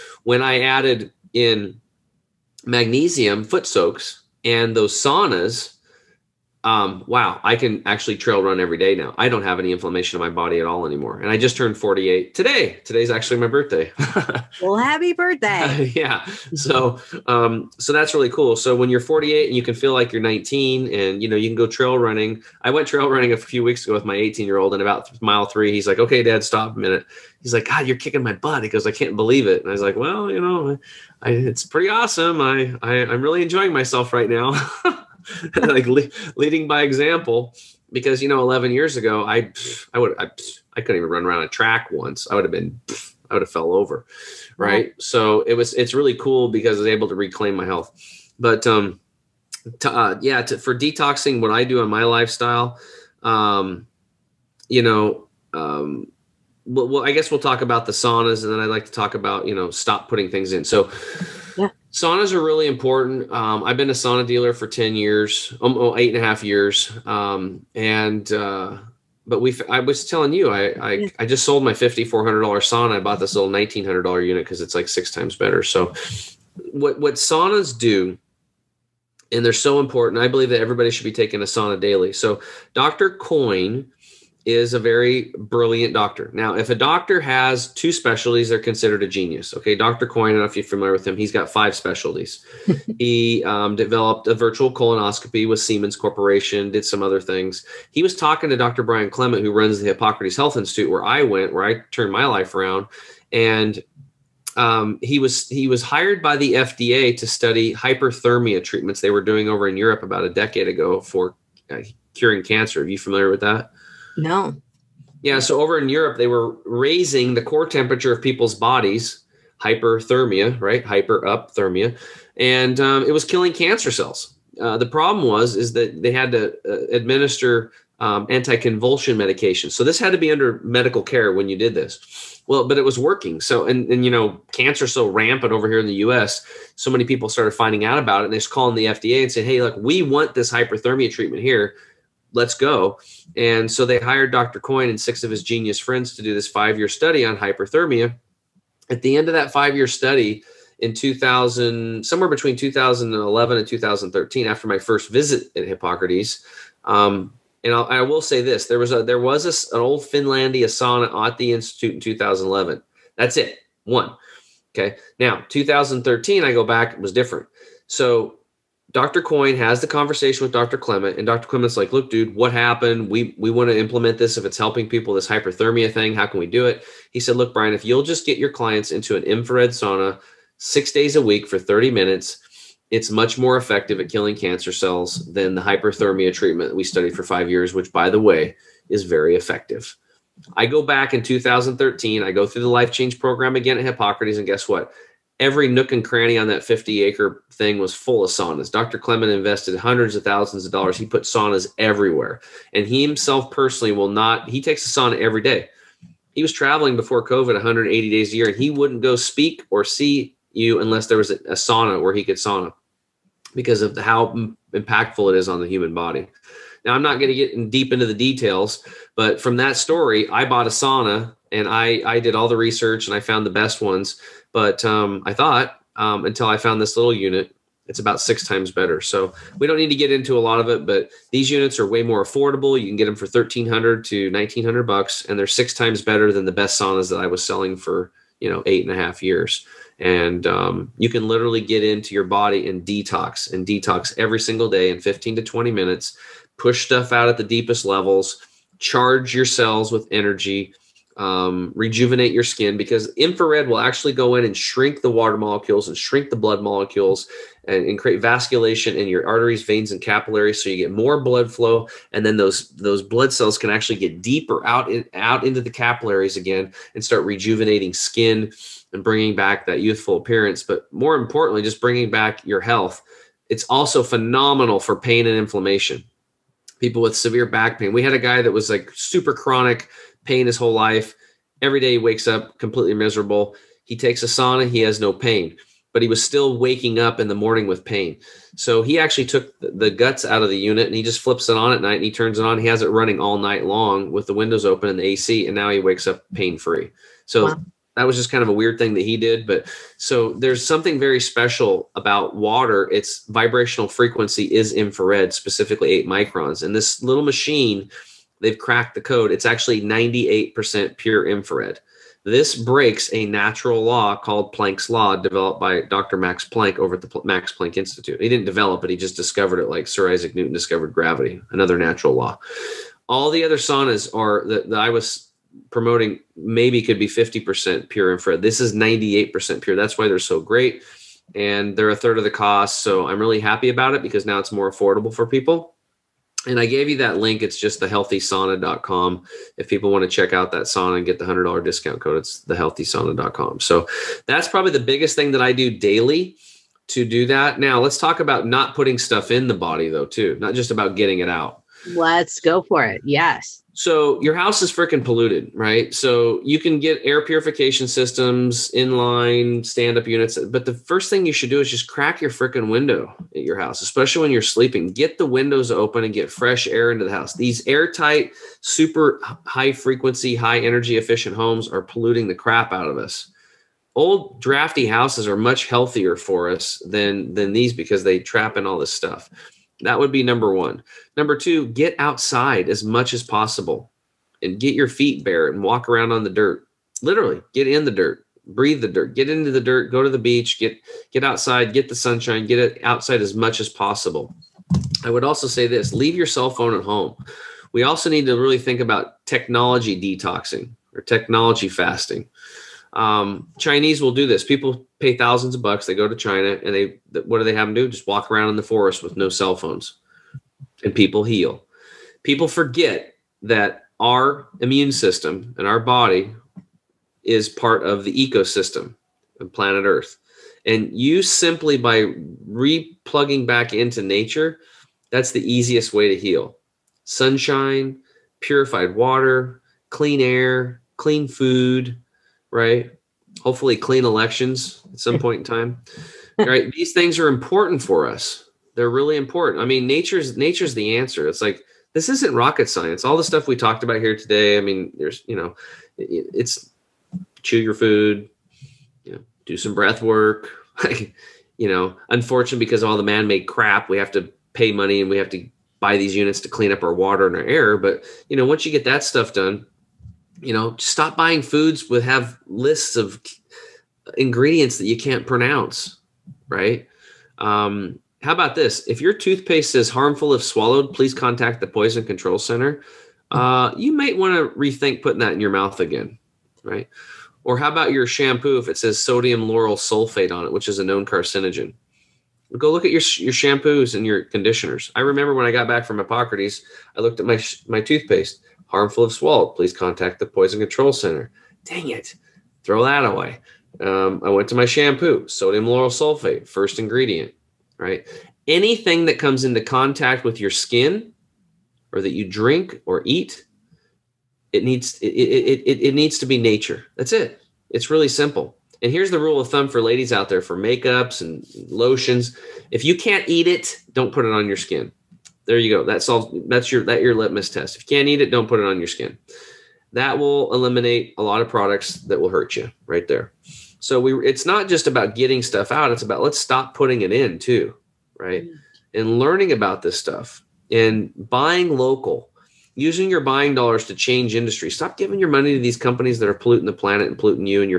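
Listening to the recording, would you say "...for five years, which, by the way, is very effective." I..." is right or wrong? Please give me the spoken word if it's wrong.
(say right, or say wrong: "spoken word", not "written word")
right.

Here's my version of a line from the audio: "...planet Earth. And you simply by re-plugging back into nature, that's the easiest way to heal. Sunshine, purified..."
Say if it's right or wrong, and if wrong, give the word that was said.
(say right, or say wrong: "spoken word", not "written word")
right.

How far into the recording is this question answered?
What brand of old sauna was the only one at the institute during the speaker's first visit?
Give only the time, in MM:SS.
02:40.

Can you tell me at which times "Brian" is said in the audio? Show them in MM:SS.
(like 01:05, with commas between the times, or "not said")
01:38, 02:57.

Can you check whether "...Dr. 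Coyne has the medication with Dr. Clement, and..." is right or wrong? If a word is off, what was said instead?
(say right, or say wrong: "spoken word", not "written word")
wrong: "conversation", not "medication".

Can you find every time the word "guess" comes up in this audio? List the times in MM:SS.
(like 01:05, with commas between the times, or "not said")
00:57, 03:14.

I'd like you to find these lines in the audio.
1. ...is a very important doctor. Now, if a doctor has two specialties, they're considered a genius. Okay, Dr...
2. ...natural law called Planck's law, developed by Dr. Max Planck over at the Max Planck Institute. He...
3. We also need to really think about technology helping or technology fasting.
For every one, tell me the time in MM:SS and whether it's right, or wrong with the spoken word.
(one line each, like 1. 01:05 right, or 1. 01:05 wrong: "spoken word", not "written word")
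1. 01:24 wrong: "brilliant", not "important"
2. 05:13 right
3. 06:37 wrong: "detoxing", not "helping".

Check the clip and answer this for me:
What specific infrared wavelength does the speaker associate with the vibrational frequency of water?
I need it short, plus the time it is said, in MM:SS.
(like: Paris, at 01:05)
8 microns, at 05:05.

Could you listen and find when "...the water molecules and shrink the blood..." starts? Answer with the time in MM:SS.
04:15.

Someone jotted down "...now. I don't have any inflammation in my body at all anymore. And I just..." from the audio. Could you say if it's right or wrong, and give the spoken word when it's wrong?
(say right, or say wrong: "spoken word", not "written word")
right.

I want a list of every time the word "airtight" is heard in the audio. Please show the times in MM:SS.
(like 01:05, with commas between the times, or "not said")
06:07.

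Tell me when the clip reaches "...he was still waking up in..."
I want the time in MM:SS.
04:46.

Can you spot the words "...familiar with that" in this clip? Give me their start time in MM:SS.
01:52.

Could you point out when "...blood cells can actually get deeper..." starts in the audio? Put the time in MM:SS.
04:23.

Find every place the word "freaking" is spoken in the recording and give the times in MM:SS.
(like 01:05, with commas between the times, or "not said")
05:54, 06:02.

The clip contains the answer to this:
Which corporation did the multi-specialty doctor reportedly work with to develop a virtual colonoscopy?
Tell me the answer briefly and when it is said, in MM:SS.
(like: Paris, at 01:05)
Siemens, at 01:35.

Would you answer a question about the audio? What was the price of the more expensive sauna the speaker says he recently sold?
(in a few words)
$5,400.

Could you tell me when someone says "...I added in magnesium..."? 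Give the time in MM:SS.
00:00.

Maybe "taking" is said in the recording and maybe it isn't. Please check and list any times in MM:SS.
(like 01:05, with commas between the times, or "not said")
01:21.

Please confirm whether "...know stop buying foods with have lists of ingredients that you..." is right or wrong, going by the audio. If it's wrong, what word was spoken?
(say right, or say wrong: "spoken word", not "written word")
right.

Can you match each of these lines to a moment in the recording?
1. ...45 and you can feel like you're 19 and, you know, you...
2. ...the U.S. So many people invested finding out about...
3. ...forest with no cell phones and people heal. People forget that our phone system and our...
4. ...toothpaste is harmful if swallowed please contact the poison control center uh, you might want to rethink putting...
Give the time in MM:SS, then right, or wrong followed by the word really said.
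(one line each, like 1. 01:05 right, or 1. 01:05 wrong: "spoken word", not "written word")
1. 00:18 wrong: "48", not "45"
2. 02:15 wrong: "started", not "invested"
3. 06:48 wrong: "immune", not "phone"
4. 07:49 right.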